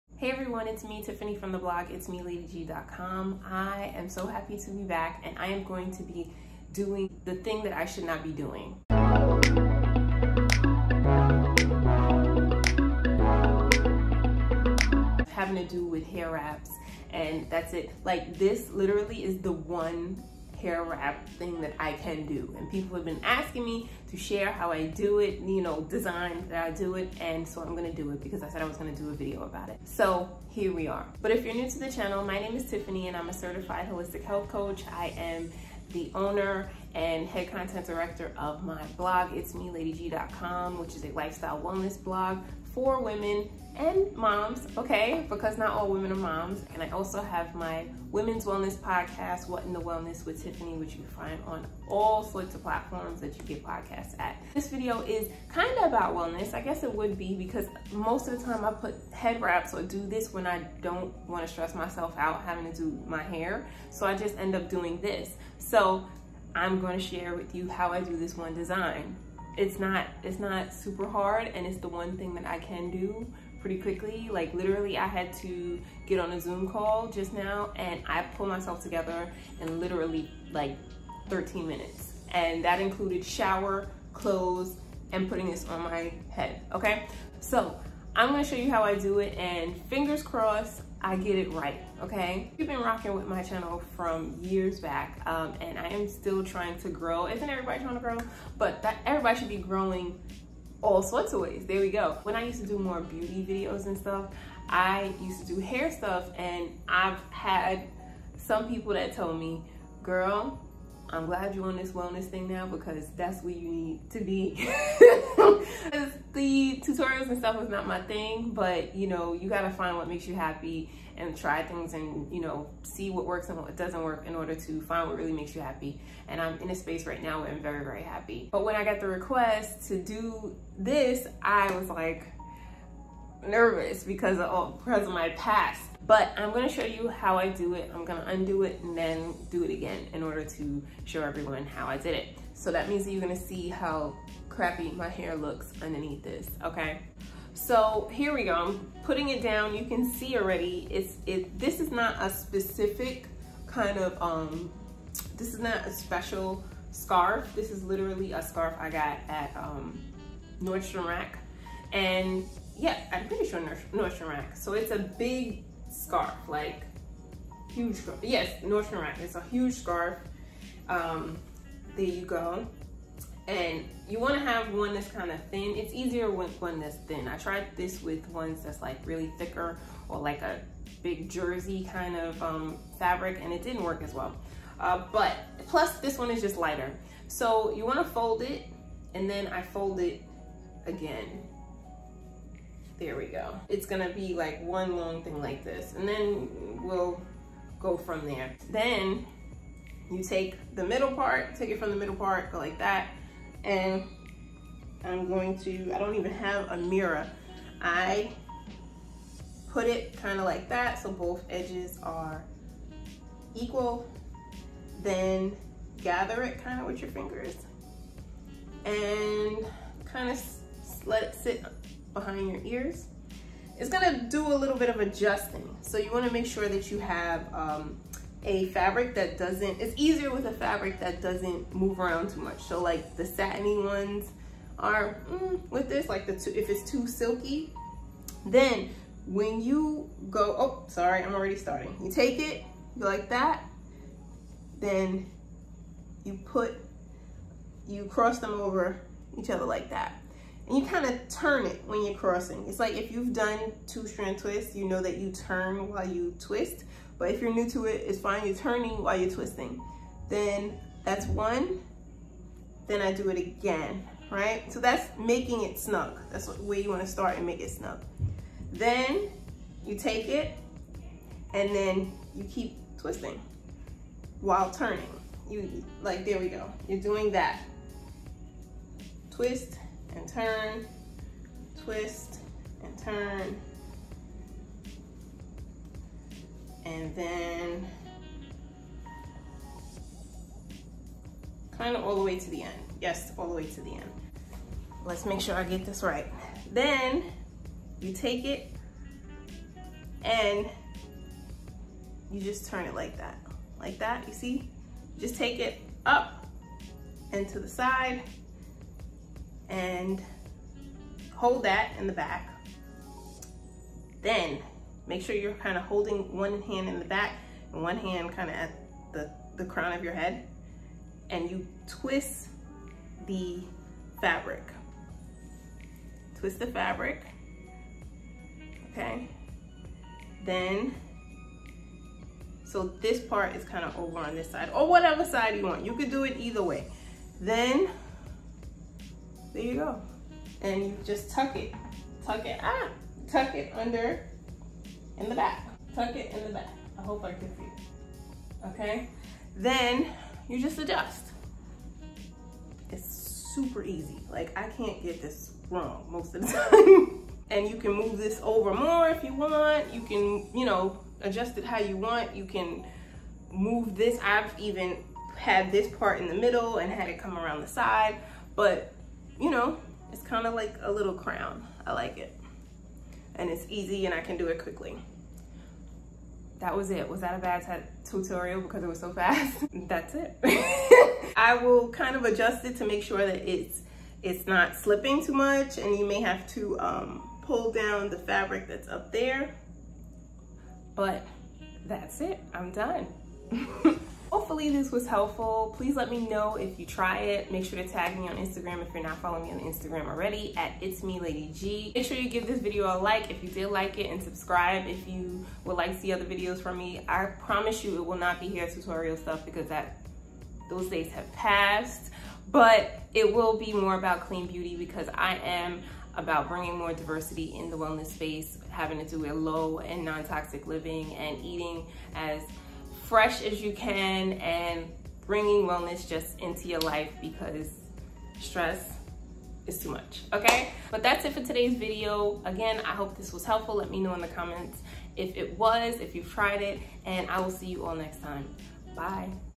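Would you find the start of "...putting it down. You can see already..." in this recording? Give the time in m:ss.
2:29.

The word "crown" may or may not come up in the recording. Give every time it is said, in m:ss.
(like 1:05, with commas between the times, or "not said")
5:19, 6:11.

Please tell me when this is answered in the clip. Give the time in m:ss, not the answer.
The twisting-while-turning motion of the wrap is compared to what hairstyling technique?
4:13.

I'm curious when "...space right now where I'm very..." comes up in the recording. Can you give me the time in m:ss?
2:06.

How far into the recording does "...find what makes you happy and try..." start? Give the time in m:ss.
1:59.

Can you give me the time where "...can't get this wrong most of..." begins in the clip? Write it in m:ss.
5:54.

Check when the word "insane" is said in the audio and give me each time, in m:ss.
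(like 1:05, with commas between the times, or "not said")
not said.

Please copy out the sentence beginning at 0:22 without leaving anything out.
And people have been asking me to share how I do it, you know, design that I do it.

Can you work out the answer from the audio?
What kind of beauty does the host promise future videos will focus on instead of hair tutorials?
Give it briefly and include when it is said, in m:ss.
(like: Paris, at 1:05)
clean beauty, at 6:54.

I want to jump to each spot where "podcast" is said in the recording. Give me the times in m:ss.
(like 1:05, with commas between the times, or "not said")
0:48, 0:53.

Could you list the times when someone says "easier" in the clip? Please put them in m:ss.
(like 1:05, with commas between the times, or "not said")
2:55, 3:49.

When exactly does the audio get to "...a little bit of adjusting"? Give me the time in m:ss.
3:44.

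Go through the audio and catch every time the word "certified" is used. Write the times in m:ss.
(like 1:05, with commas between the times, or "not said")
0:33.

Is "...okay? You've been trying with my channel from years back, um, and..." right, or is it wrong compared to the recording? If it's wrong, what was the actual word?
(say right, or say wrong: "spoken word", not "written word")
wrong: "rocking", not "trying".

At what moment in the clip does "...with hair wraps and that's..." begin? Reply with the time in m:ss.
0:15.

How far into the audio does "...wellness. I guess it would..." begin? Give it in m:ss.
0:56.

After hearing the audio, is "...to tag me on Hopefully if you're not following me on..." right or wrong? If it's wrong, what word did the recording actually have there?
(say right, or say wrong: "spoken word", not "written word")
wrong: "Instagram", not "Hopefully".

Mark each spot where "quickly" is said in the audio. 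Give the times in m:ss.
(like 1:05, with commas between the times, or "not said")
1:13, 6:14.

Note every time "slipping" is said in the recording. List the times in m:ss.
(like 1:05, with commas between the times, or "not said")
6:24.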